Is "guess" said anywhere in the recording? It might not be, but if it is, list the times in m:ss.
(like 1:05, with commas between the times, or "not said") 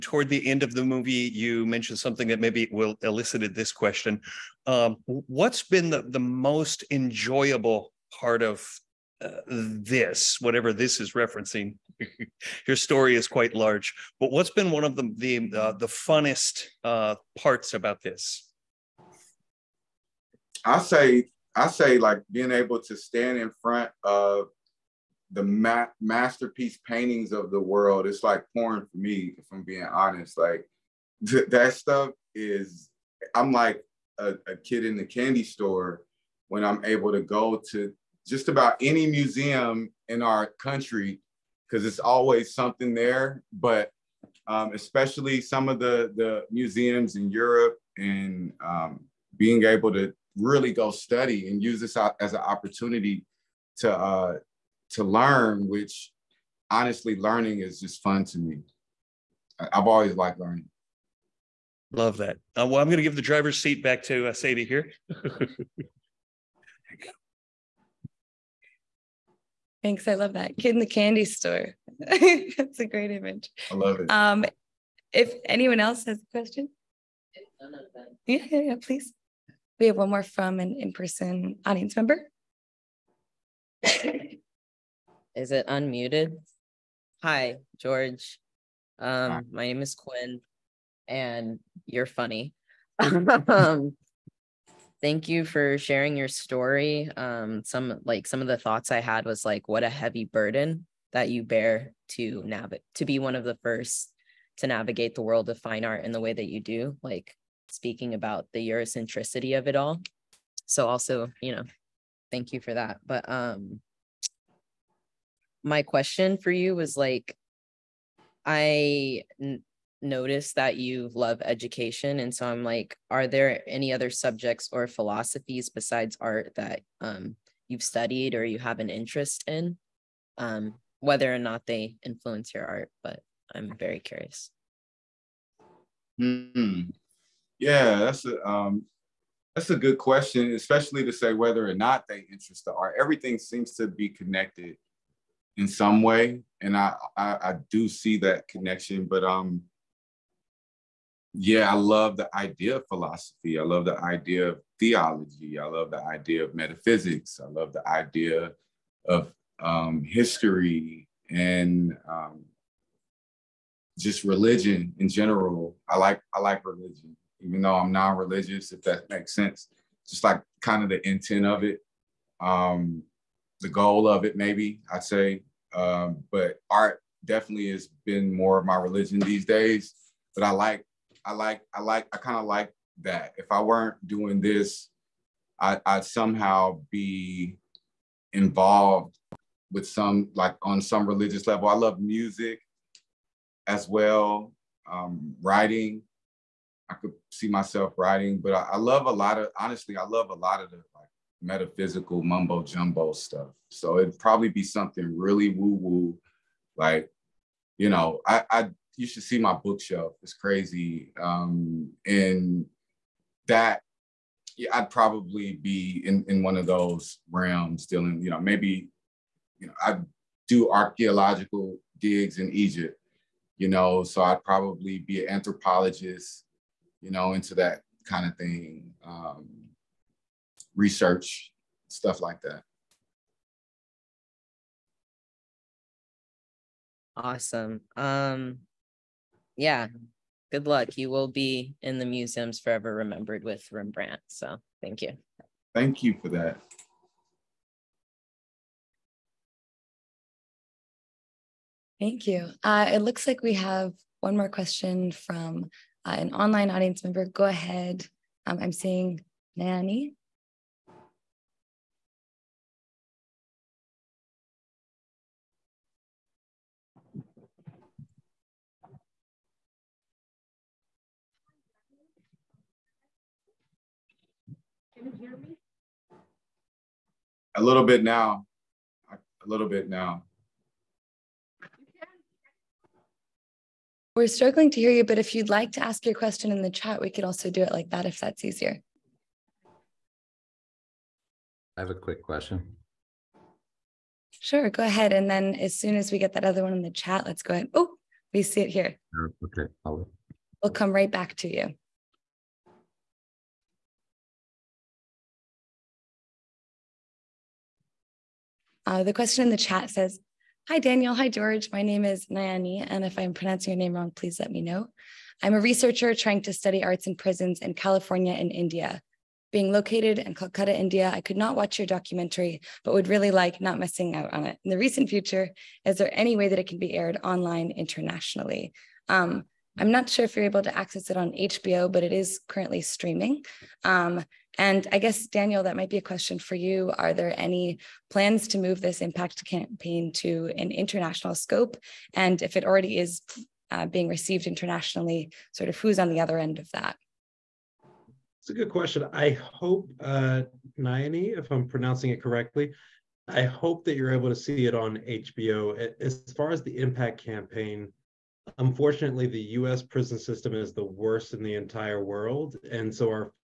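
5:34.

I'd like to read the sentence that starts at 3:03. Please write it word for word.
If I weren't doing this, I, would somehow be involved with some, like on some religious level.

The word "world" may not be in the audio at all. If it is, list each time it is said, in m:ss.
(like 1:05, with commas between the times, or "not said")
0:27, 1:45, 6:02.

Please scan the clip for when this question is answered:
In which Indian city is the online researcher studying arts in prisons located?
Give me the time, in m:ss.
5:20.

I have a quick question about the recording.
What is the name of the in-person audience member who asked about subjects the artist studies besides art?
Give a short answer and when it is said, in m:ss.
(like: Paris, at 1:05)
Quinn, at 1:29.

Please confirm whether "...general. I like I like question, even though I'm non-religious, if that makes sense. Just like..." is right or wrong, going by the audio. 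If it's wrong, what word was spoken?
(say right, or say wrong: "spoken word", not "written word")
wrong: "religion", not "question".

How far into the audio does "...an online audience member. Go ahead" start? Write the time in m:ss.
4:16.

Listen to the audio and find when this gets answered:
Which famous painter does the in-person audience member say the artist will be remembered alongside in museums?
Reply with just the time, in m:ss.
4:03.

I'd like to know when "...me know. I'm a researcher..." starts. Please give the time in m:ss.
5:14.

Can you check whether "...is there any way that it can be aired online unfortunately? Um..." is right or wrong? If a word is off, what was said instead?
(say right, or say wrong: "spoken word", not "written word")
wrong: "internationally", not "unfortunately".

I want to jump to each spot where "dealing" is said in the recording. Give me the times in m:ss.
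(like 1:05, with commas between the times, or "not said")
3:37.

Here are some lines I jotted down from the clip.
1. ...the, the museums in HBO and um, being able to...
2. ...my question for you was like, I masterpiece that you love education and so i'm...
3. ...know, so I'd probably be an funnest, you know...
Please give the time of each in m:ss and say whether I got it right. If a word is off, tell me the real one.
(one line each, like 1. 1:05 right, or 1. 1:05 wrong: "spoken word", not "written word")
1. 0:45 wrong: "Europe", not "HBO"
2. 1:55 wrong: "notice", not "masterpiece"
3. 3:43 wrong: "anthropologist", not "funnest".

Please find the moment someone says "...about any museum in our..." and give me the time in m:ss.
0:38.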